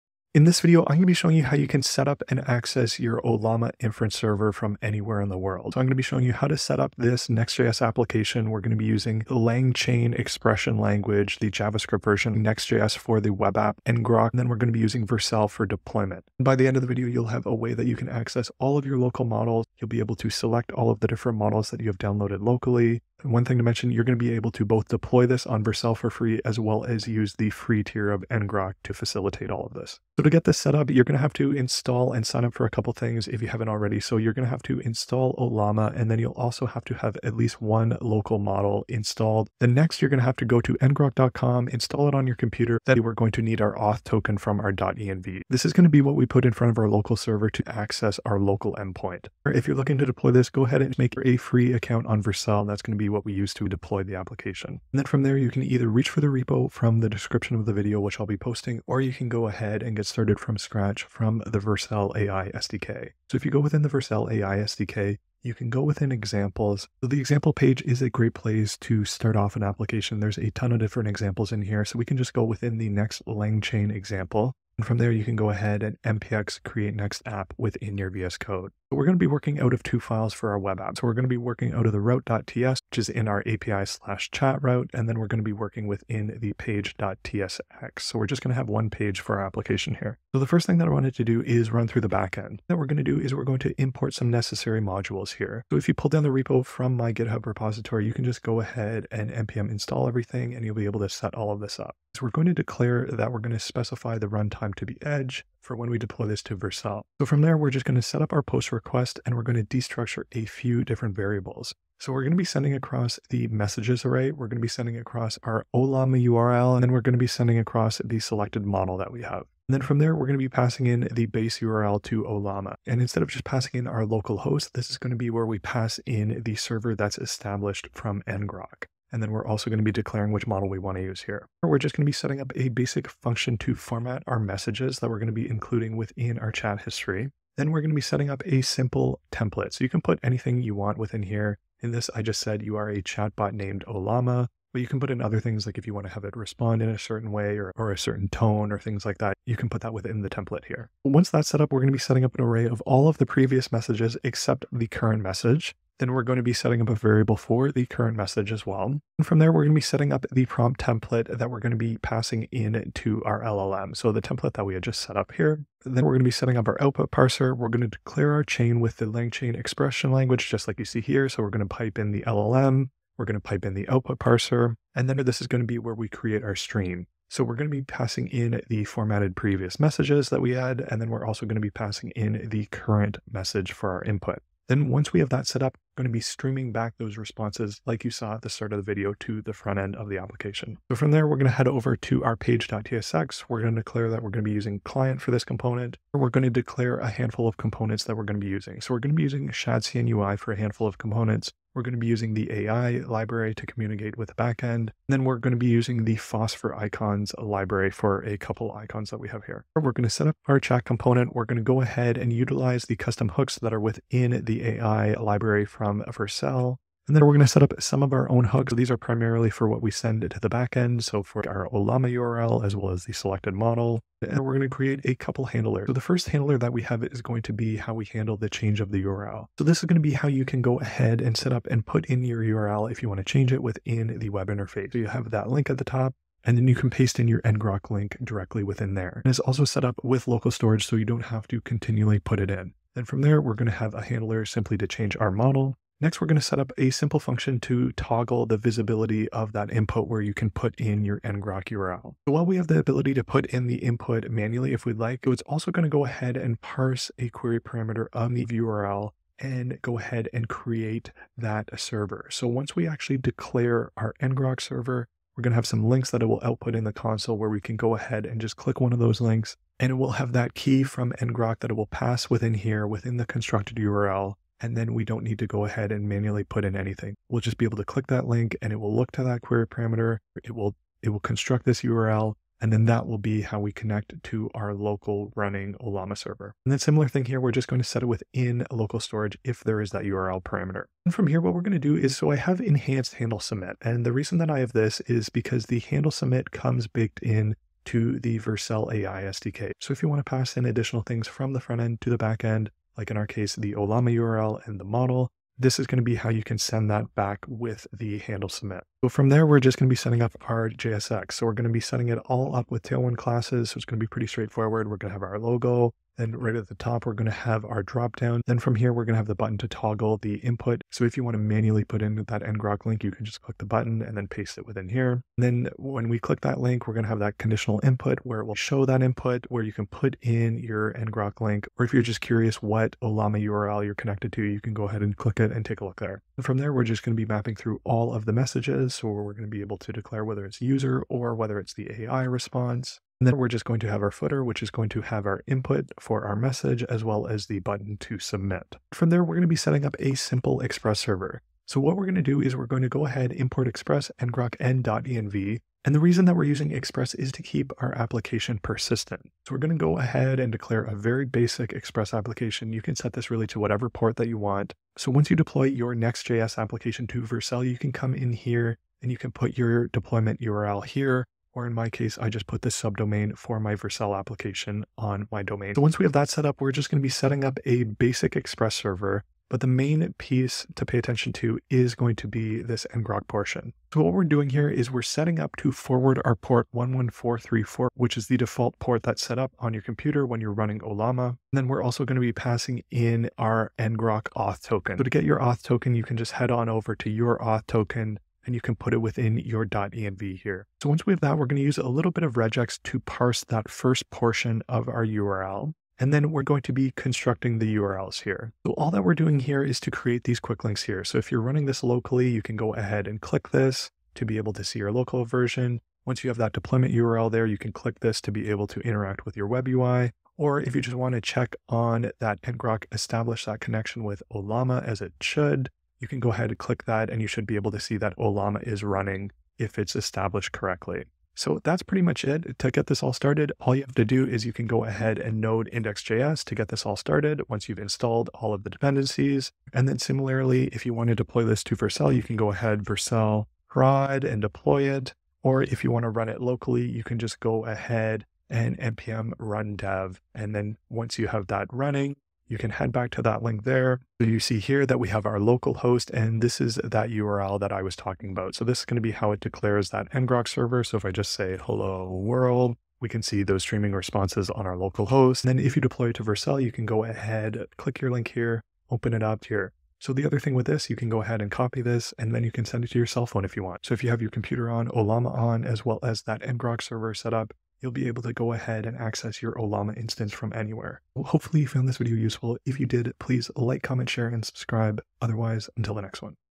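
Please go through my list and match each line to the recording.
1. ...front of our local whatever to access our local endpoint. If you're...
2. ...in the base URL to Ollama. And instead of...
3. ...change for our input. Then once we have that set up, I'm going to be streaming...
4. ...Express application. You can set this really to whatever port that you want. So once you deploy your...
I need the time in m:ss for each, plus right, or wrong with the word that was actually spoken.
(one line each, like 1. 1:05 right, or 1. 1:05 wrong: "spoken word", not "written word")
1. 0:46 wrong: "server", not "whatever"
2. 2:00 right
3. 3:03 wrong: "message", not "change"
4. 6:01 right.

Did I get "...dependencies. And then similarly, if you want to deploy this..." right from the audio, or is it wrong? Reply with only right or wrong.
right.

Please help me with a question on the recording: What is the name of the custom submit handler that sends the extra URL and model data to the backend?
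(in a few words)
enhanced handle submit.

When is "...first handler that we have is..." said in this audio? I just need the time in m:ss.
3:45.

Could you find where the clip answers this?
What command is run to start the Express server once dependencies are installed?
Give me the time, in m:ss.
7:15.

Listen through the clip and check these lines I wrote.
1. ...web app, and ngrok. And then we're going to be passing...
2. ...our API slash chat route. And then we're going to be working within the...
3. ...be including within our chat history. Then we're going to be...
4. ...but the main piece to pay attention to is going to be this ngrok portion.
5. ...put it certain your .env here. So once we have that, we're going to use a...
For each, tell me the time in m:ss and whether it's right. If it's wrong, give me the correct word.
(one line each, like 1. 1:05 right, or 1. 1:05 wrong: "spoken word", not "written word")
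1. 0:13 wrong: "using", not "passing"
2. 1:23 right
3. 2:15 right
4. 6:19 right
5. 6:38 wrong: "within", not "certain".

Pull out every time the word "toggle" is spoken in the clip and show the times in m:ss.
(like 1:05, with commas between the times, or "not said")
4:07, 5:19.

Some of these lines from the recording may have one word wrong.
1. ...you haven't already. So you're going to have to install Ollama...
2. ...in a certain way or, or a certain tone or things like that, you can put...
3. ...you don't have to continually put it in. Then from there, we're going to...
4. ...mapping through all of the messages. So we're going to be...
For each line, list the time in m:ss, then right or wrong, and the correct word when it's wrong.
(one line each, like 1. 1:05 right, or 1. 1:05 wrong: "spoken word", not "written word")
1. 0:33 right
2. 2:26 right
3. 4:00 right
4. 5:37 right.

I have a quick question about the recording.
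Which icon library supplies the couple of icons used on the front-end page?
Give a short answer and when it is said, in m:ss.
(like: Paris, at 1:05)
phosphor icons, at 3:26.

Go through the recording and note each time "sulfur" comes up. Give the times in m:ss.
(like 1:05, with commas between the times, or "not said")
not said.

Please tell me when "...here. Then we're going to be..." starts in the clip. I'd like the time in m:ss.
2:45.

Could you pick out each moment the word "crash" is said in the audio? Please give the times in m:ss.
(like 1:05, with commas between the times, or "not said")
not said.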